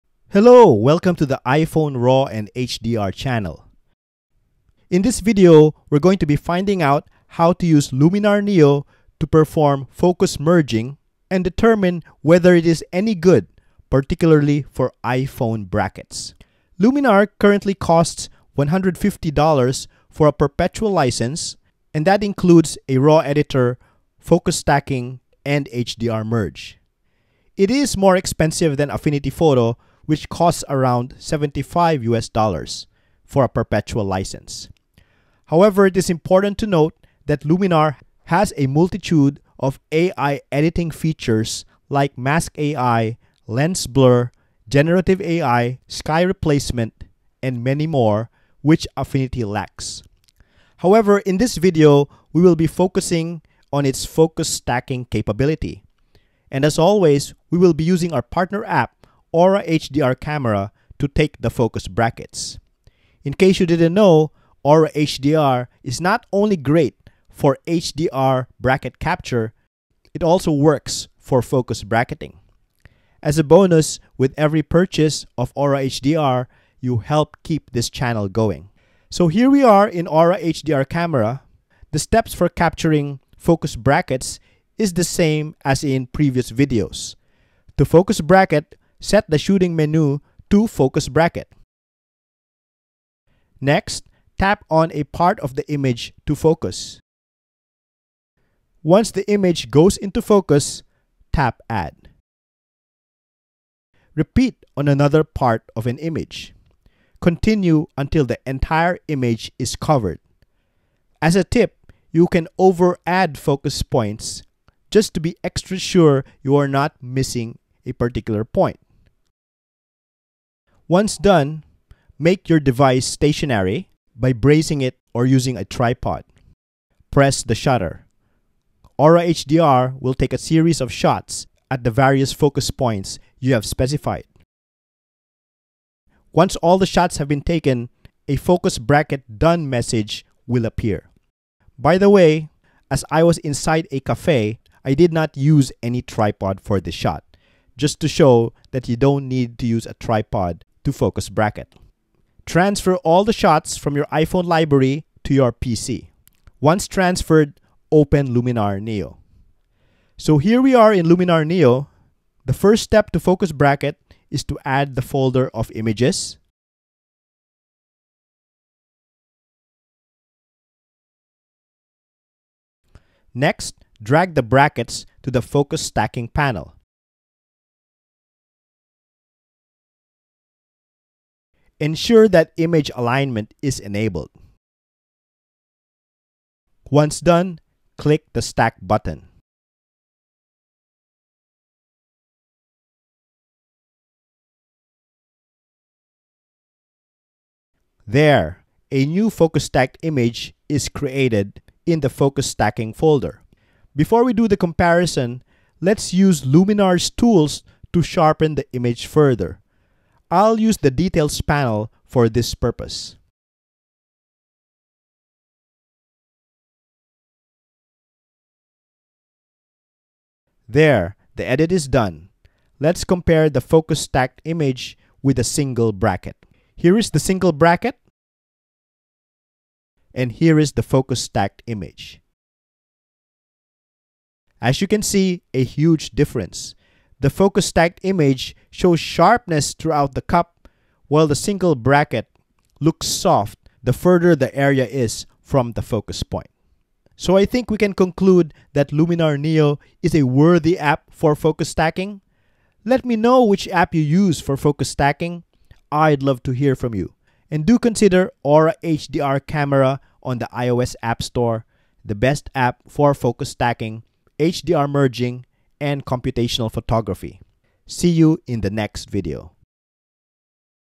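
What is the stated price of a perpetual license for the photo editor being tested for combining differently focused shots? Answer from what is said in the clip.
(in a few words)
$150.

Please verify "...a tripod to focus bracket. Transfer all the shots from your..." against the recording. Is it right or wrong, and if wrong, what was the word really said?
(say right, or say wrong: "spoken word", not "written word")
right.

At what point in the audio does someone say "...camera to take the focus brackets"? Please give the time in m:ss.
1:00.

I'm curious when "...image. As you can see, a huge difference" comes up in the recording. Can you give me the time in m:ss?
3:51.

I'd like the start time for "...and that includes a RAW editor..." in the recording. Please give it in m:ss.
0:21.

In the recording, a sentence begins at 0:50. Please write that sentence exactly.
However, in this video, we will be focusing on its focus stacking capability.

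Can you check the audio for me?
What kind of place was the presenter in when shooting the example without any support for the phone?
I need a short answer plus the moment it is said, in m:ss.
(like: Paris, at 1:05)
a cafe, at 2:23.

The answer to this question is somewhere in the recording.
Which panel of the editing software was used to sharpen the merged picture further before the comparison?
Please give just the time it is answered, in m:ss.
3:30.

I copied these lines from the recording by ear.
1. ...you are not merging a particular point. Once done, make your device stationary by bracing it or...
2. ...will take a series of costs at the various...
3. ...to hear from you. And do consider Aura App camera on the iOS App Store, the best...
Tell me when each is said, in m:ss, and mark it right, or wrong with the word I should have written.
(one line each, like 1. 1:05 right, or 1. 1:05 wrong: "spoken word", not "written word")
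1. 1:56 wrong: "missing", not "merging"
2. 2:10 wrong: "shots", not "costs"
3. 4:16 wrong: "HDR", not "App".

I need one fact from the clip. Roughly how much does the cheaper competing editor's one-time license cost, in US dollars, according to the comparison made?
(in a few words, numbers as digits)
75.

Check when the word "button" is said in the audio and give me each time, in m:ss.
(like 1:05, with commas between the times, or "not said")
3:08.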